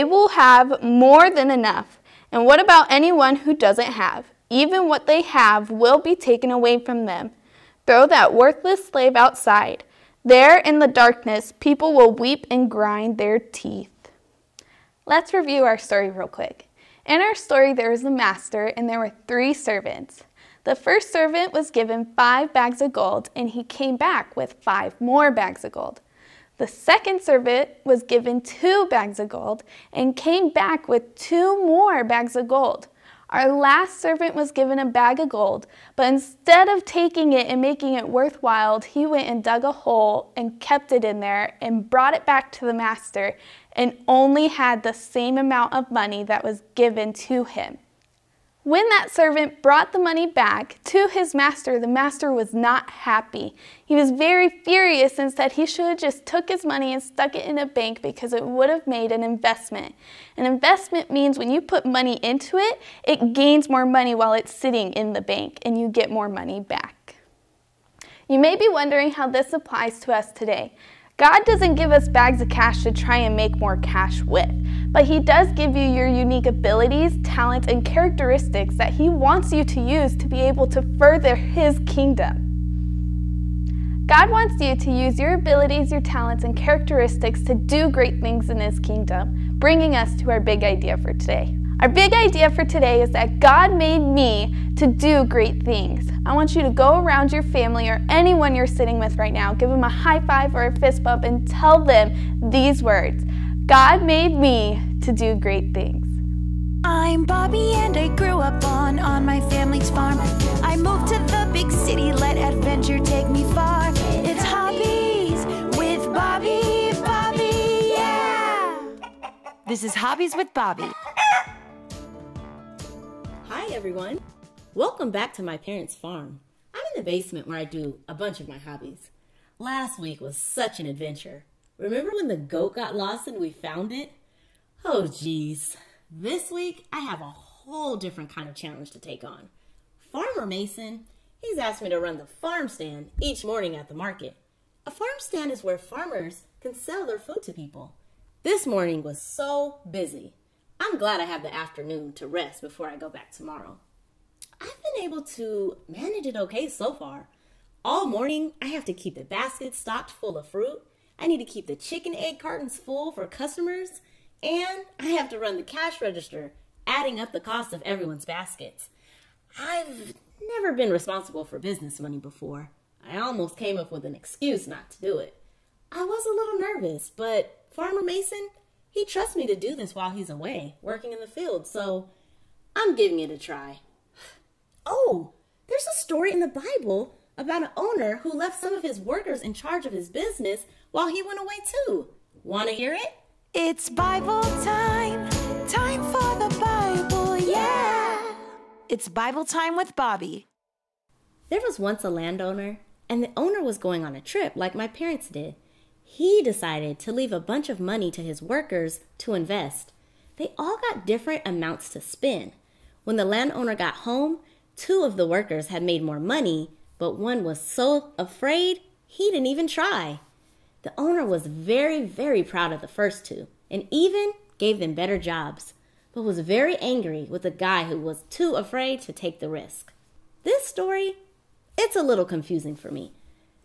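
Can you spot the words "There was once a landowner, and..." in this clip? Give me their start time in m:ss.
3:21.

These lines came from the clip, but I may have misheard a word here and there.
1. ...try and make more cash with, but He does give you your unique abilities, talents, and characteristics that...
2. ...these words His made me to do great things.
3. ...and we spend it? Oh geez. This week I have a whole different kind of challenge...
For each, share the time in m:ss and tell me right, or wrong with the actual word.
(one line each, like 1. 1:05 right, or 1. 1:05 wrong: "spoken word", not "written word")
1. 1:12 right
2. 1:42 wrong: "God", not "His"
3. 2:13 wrong: "found", not "spend".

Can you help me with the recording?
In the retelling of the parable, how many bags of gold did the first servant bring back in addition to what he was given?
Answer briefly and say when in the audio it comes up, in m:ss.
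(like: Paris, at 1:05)
5, at 0:24.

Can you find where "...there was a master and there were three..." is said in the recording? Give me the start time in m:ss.
0:17.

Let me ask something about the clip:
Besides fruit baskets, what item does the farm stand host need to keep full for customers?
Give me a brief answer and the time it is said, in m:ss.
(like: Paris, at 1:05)
chicken egg cartons, at 2:41.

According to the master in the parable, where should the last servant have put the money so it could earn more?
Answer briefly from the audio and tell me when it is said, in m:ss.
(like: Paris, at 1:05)
a bank, at 0:57.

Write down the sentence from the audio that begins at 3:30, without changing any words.
They all got different amounts to spend.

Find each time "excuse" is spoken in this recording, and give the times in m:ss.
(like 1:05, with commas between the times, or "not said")
2:54.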